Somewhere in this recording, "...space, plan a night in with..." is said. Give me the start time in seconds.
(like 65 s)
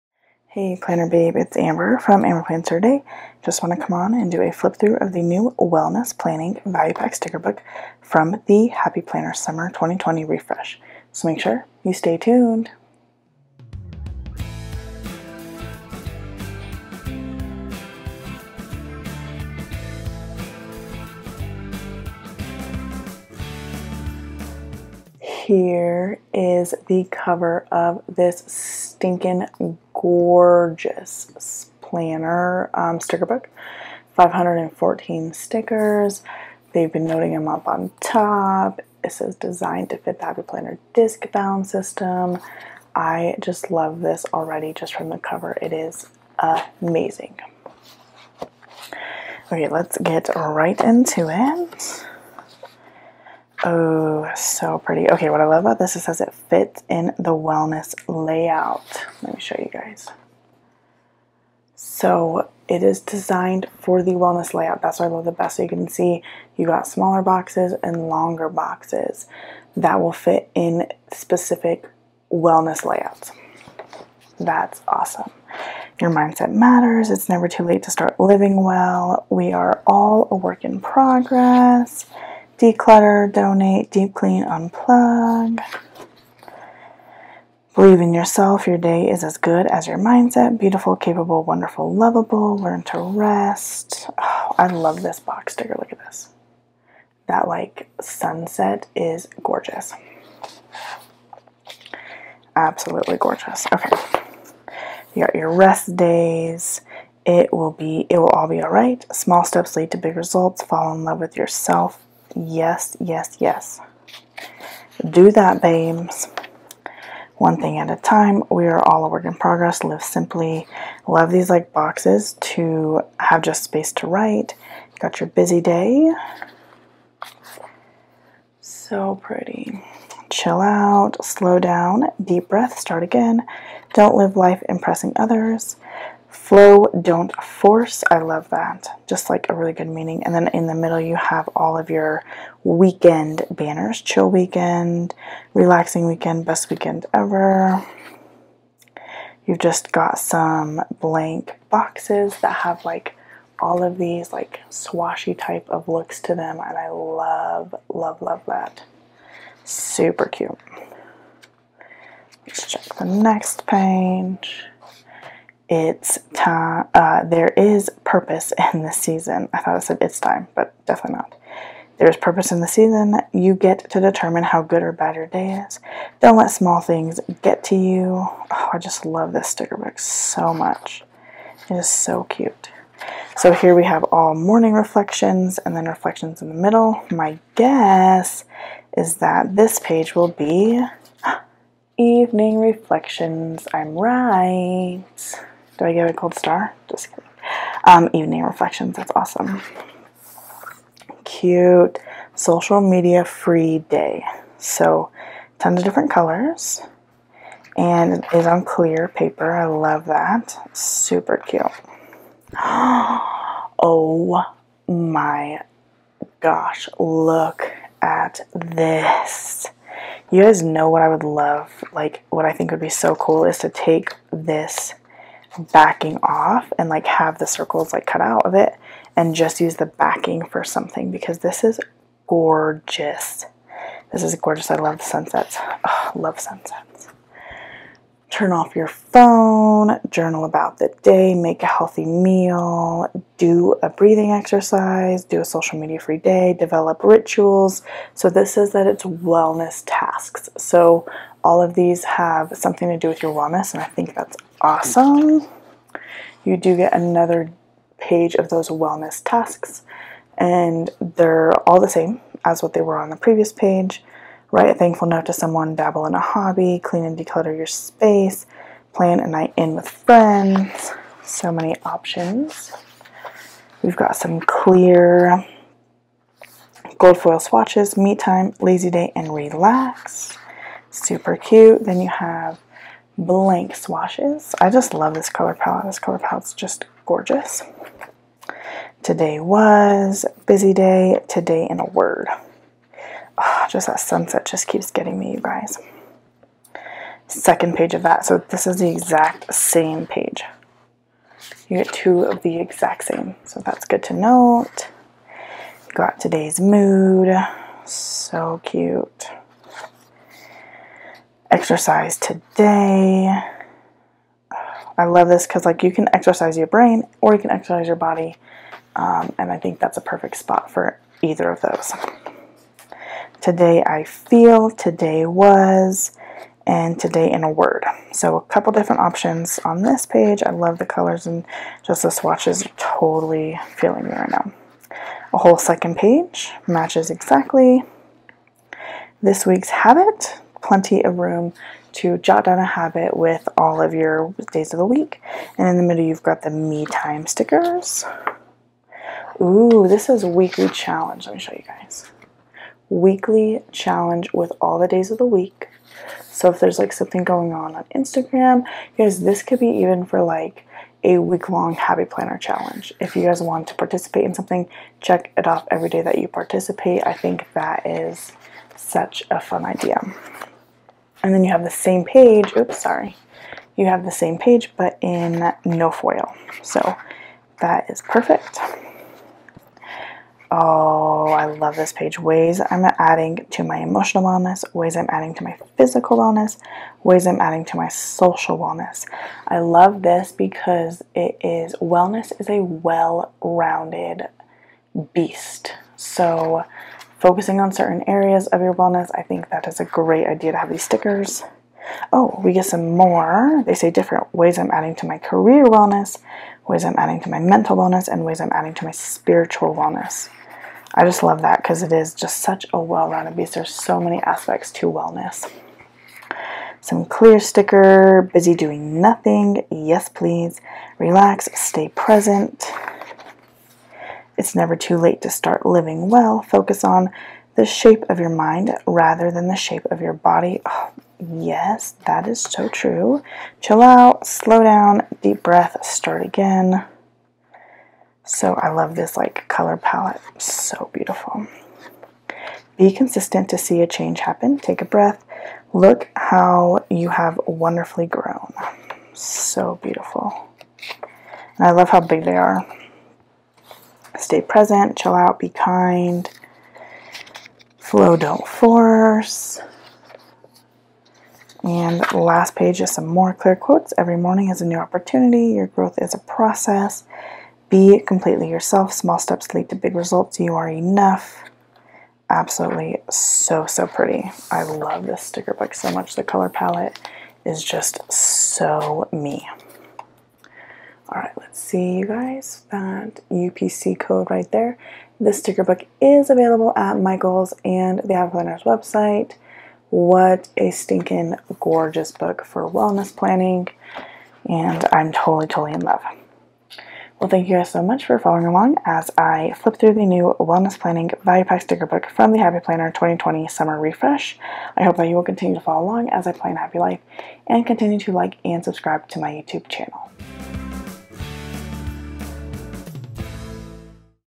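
267 s.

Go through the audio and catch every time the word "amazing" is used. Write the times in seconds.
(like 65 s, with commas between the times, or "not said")
46 s.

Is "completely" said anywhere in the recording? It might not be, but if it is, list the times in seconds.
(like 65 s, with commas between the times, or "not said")
468 s.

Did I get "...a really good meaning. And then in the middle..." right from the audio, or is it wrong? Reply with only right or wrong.
right.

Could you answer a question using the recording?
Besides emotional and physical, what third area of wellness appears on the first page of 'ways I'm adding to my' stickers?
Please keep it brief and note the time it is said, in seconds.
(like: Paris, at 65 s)
Social wellness, at 387 s.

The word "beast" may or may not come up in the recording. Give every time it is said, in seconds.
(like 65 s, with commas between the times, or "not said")
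395 s, 413 s.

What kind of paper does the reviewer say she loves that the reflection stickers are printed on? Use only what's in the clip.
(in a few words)
Clear paper.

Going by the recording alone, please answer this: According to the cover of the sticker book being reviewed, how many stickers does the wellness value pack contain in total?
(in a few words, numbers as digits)
514.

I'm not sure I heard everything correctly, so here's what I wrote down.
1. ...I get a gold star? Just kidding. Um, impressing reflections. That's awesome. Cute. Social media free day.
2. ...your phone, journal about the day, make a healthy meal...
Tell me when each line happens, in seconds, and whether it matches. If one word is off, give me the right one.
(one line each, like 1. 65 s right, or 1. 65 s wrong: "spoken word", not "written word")
1. 195 s wrong: "evening", not "impressing"
2. 238 s right.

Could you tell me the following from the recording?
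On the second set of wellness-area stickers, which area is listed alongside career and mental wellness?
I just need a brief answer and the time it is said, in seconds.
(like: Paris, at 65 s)
Spiritual wellness, at 408 s.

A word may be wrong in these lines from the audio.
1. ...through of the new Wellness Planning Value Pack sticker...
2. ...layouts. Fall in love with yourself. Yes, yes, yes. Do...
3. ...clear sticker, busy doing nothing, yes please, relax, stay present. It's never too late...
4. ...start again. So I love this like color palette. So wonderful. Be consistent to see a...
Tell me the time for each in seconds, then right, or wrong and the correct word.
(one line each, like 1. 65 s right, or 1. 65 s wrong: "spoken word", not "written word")
1. 4 s right
2. 110 s wrong: "results", not "layouts"
3. 417 s right
4. 435 s wrong: "beautiful", not "wonderful".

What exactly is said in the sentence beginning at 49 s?
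Okay, let's get right into it.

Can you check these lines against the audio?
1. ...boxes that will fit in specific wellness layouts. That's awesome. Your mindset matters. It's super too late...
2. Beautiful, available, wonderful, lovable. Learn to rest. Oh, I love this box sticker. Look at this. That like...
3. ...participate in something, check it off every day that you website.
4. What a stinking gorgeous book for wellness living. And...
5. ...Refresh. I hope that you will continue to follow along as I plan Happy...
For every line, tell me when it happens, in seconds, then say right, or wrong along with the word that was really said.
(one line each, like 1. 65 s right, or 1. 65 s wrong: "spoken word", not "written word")
1. 68 s wrong: "never", not "super"
2. 90 s wrong: "capable", not "available"
3. 363 s wrong: "participate", not "website"
4. 489 s wrong: "planning", not "living"
5. 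503 s right.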